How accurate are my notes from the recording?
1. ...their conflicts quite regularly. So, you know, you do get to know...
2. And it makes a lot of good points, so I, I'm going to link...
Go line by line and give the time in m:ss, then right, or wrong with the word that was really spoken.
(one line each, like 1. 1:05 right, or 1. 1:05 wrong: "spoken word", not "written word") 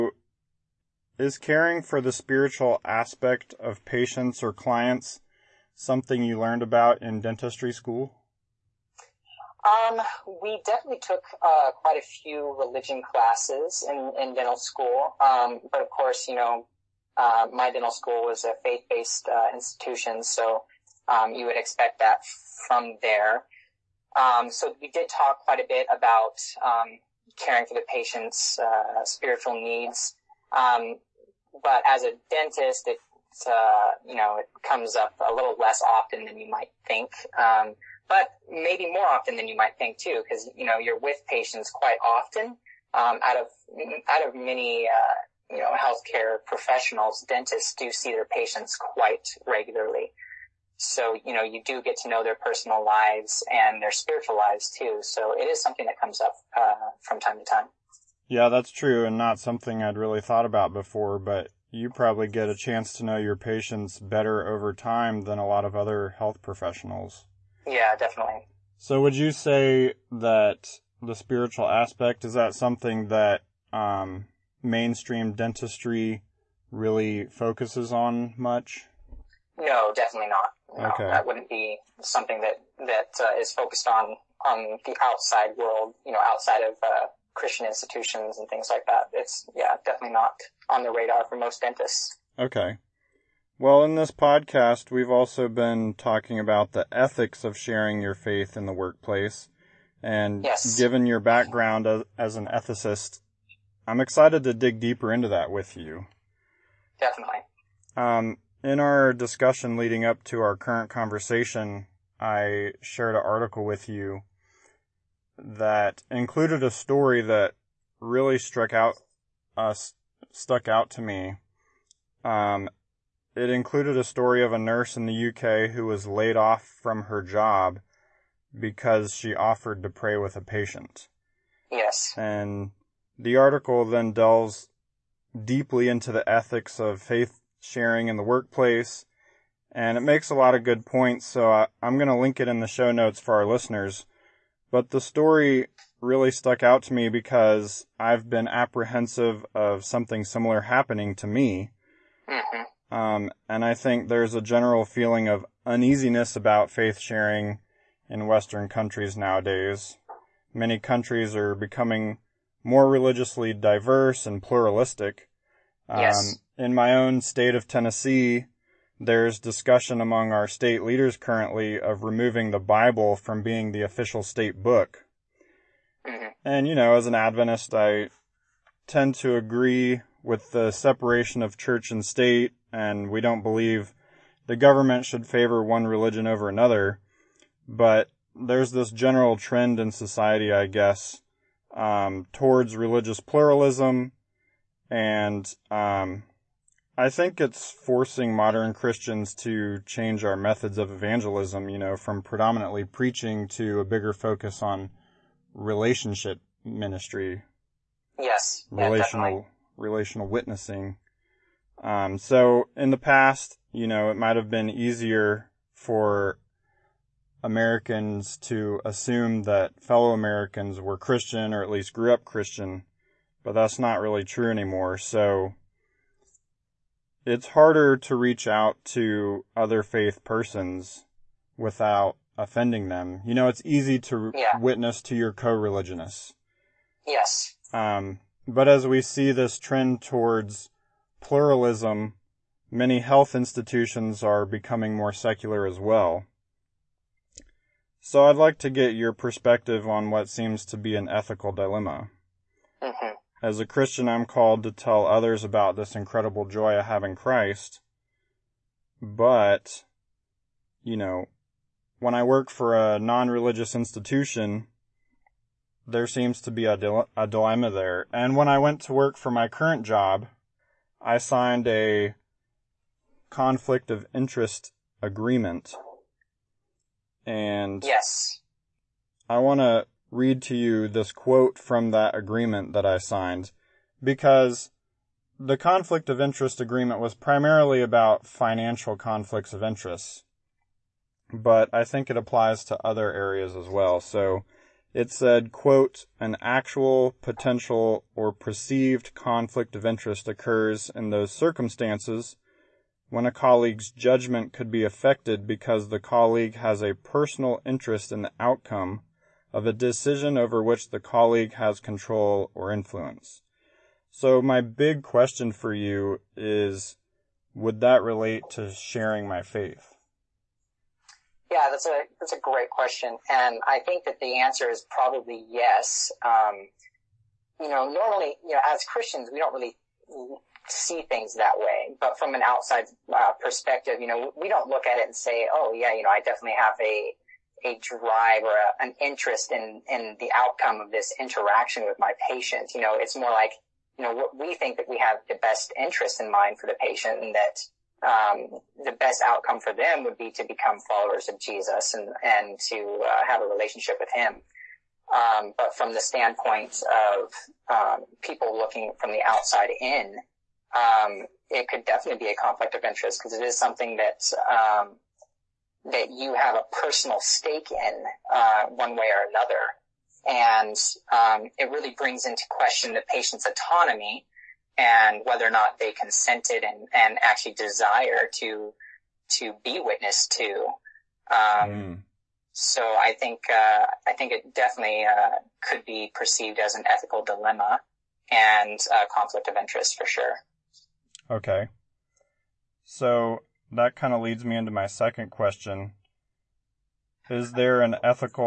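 1. 0:48 wrong: "patients", not "conflicts"
2. 2:19 right.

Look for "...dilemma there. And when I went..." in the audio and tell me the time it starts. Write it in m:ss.
4:27.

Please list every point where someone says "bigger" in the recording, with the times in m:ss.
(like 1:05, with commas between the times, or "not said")
3:23.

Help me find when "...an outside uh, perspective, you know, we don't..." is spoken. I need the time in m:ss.
5:32.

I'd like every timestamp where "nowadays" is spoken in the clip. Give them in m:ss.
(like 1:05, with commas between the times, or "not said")
2:39.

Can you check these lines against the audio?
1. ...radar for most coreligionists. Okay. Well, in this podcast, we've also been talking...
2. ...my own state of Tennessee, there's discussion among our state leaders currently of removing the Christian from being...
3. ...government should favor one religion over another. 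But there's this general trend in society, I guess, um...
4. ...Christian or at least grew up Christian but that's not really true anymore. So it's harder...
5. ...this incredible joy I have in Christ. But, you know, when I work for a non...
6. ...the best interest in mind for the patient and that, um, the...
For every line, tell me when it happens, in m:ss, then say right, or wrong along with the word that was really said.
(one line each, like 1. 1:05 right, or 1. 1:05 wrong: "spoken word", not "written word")
1. 1:30 wrong: "dentists", not "coreligionists"
2. 2:46 wrong: "Bible", not "Christian"
3. 3:04 right
4. 3:40 right
5. 4:15 right
6. 5:45 right.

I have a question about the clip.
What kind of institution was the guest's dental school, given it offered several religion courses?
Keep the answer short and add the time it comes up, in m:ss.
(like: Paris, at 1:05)
faith-based, at 0:18.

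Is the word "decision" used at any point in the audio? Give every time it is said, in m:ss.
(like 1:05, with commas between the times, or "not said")
5:09.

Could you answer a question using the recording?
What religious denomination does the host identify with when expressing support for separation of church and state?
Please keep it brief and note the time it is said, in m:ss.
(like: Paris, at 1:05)
Adventist, at 2:57.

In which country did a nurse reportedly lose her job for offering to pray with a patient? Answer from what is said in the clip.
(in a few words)
UK.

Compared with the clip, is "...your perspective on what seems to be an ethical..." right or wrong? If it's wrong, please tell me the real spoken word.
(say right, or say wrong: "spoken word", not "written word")
right.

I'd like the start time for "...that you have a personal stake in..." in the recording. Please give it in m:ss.
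6:05.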